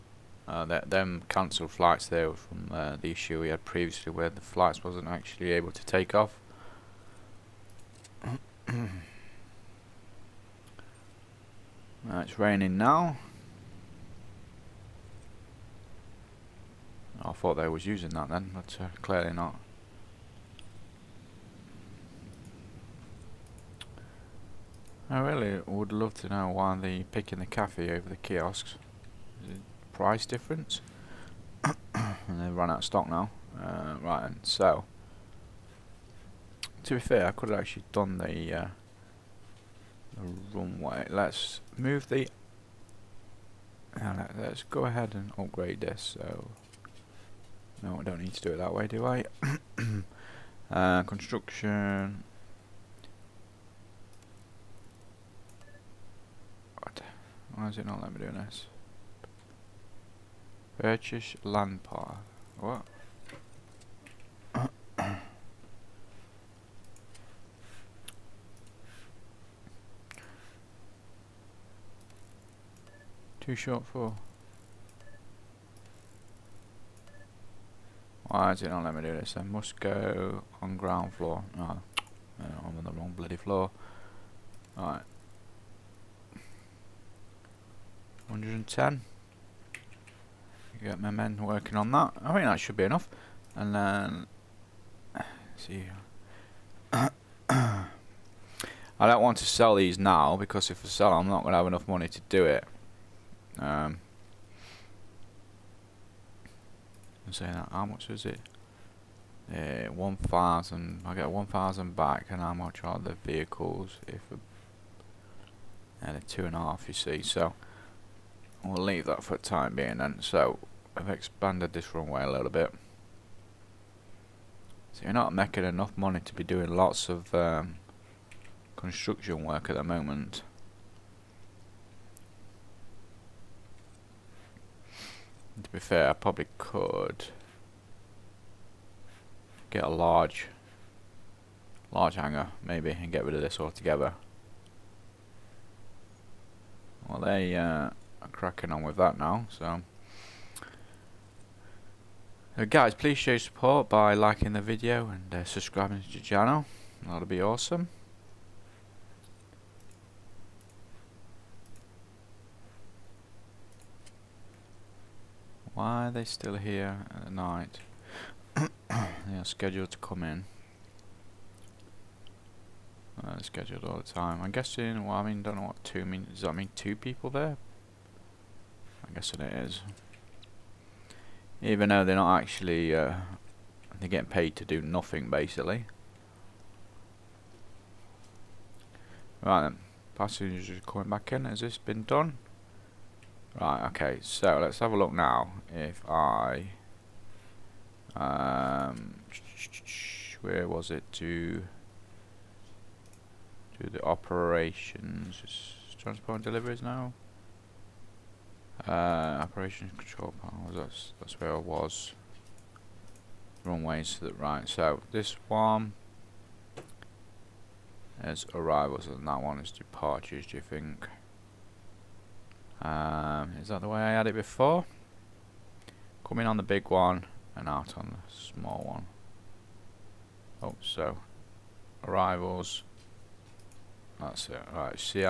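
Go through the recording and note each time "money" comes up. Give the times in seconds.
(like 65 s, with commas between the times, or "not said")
101 s, 125 s.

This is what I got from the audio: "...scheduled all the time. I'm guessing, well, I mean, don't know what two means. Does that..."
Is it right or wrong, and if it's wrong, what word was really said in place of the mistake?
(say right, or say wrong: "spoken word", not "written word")
right.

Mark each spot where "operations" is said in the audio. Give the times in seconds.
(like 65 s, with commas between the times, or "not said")
204 s, 209 s.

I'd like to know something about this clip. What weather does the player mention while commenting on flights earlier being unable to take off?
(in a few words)
Raining.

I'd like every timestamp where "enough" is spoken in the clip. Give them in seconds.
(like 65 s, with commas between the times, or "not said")
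92 s, 101 s, 125 s.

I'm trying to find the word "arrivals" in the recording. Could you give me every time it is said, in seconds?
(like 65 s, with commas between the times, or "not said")
218 s, 232 s.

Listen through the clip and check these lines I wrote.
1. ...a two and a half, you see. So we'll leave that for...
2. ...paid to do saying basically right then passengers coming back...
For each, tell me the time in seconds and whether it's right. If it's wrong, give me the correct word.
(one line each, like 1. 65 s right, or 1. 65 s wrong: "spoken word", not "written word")
1. 116 s right
2. 184 s wrong: "nothing", not "saying".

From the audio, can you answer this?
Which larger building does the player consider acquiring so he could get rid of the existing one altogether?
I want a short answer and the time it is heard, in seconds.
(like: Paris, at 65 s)
Large hangar, at 141 s.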